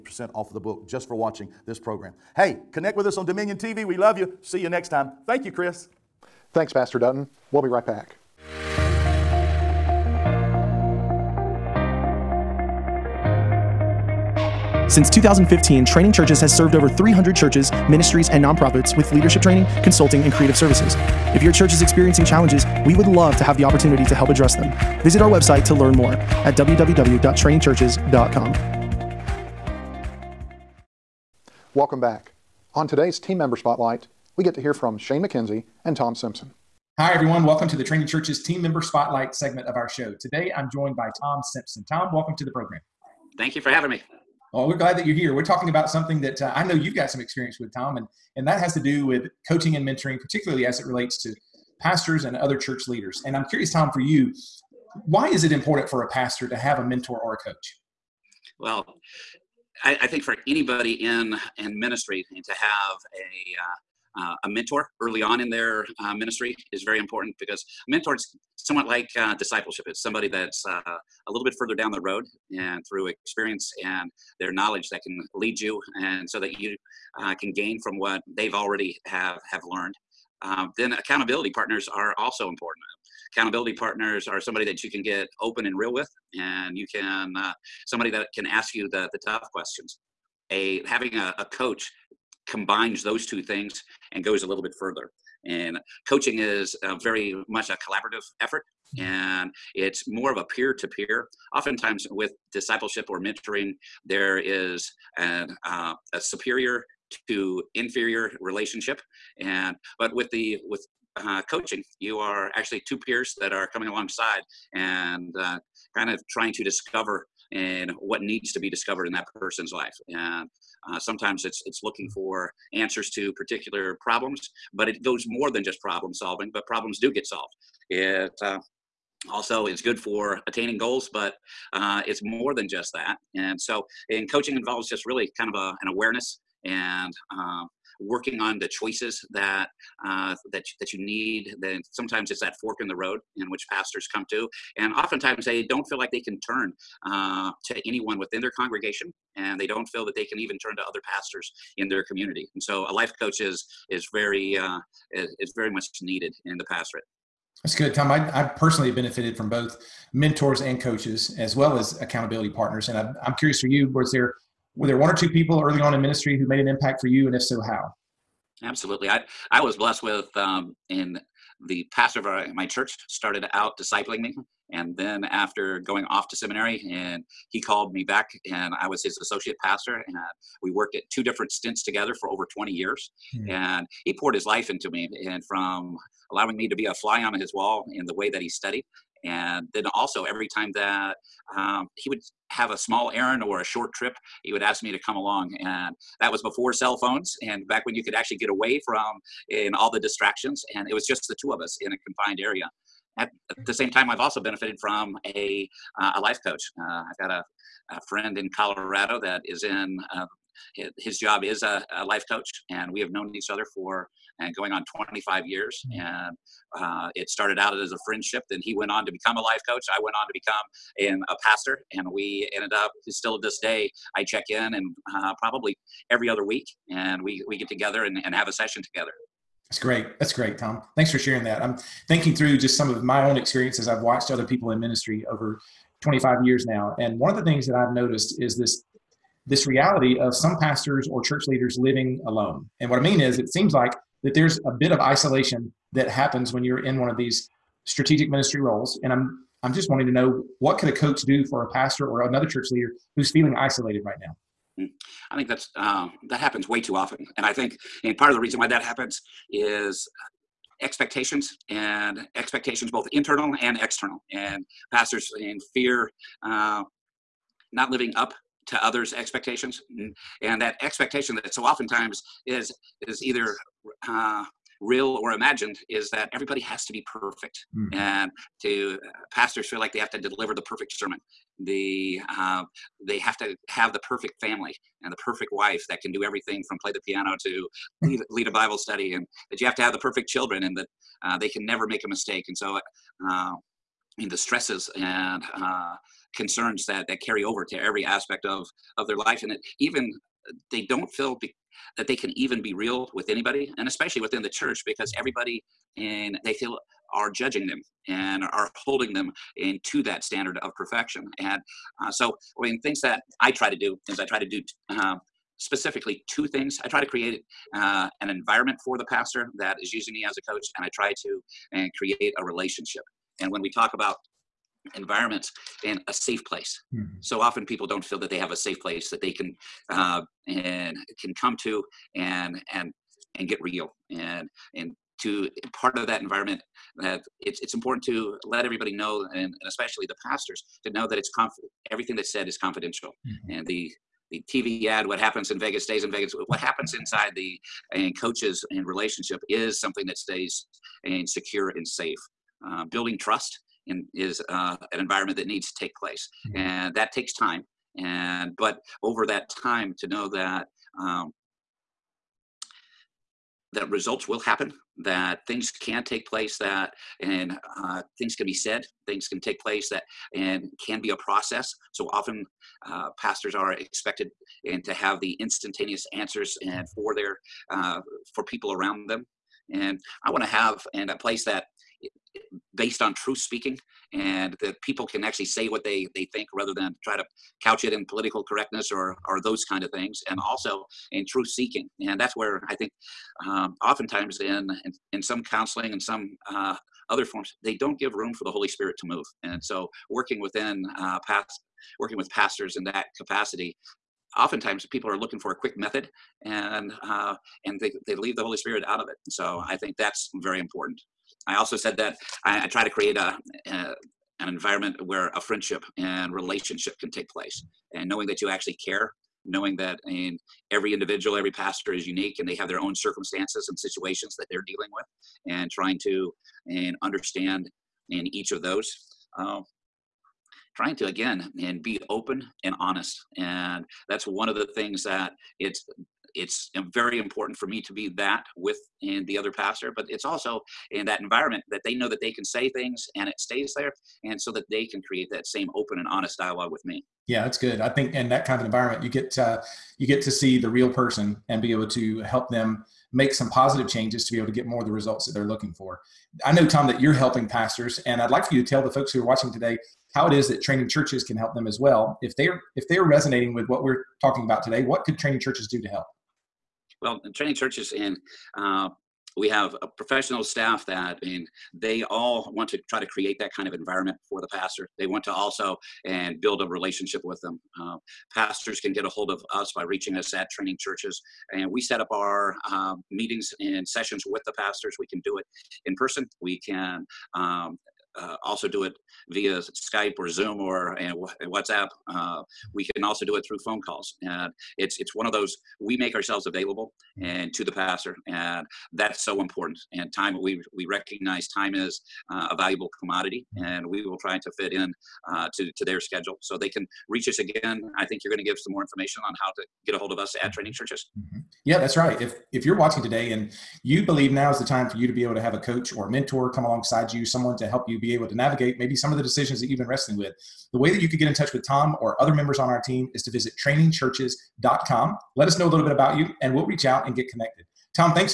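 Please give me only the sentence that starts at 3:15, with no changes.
And that was before cell phones and back when you could actually get away from in all the distractions.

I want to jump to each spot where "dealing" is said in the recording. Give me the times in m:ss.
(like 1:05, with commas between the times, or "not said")
7:04.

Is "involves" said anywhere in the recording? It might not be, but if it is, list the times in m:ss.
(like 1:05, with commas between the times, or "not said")
2:14.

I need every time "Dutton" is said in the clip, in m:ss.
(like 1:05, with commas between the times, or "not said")
0:06.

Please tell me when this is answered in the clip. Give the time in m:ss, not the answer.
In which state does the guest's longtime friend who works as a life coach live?
3:28.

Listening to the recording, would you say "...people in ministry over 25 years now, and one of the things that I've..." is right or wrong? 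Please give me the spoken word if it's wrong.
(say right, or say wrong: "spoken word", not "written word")
right.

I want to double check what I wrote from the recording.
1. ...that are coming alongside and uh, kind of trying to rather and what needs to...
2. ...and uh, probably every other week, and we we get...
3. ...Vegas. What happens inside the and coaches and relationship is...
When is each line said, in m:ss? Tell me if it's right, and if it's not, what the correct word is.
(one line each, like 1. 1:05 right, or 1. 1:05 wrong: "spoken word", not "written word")
1. 1:53 wrong: "discover", not "rather"
2. 3:44 right
3. 5:46 right.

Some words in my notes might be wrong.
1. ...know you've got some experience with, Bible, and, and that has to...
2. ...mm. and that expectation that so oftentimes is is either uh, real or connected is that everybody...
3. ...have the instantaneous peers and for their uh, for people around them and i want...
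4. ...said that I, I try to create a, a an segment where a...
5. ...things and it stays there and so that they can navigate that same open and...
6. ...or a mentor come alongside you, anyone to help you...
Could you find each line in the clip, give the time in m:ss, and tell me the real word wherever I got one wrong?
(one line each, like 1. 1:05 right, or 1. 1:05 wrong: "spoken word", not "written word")
1. 0:46 wrong: "Tom", not "Bible"
2. 4:29 wrong: "imagined", not "connected"
3. 6:14 wrong: "answers", not "peers"
4. 6:51 wrong: "environment", not "segment"
5. 7:22 wrong: "create", not "navigate"
6. 8:35 wrong: "someone", not "anyone".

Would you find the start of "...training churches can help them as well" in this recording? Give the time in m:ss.
7:40.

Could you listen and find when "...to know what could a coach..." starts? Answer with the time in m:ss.
4:10.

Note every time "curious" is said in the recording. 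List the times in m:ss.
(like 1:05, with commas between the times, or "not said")
0:53, 2:43.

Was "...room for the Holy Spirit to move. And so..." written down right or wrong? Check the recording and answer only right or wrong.
right.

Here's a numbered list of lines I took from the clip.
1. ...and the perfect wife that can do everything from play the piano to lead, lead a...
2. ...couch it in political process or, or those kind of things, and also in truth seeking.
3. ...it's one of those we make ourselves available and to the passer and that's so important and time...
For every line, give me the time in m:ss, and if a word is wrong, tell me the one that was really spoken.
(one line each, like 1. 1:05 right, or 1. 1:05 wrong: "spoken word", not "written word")
1. 4:45 right
2. 6:27 wrong: "correctness", not "process"
3. 8:14 right.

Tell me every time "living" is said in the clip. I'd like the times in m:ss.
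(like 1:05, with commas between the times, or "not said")
4:01, 4:27.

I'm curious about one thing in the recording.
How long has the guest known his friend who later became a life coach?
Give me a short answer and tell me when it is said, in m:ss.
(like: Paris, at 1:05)
25 years, at 3:34.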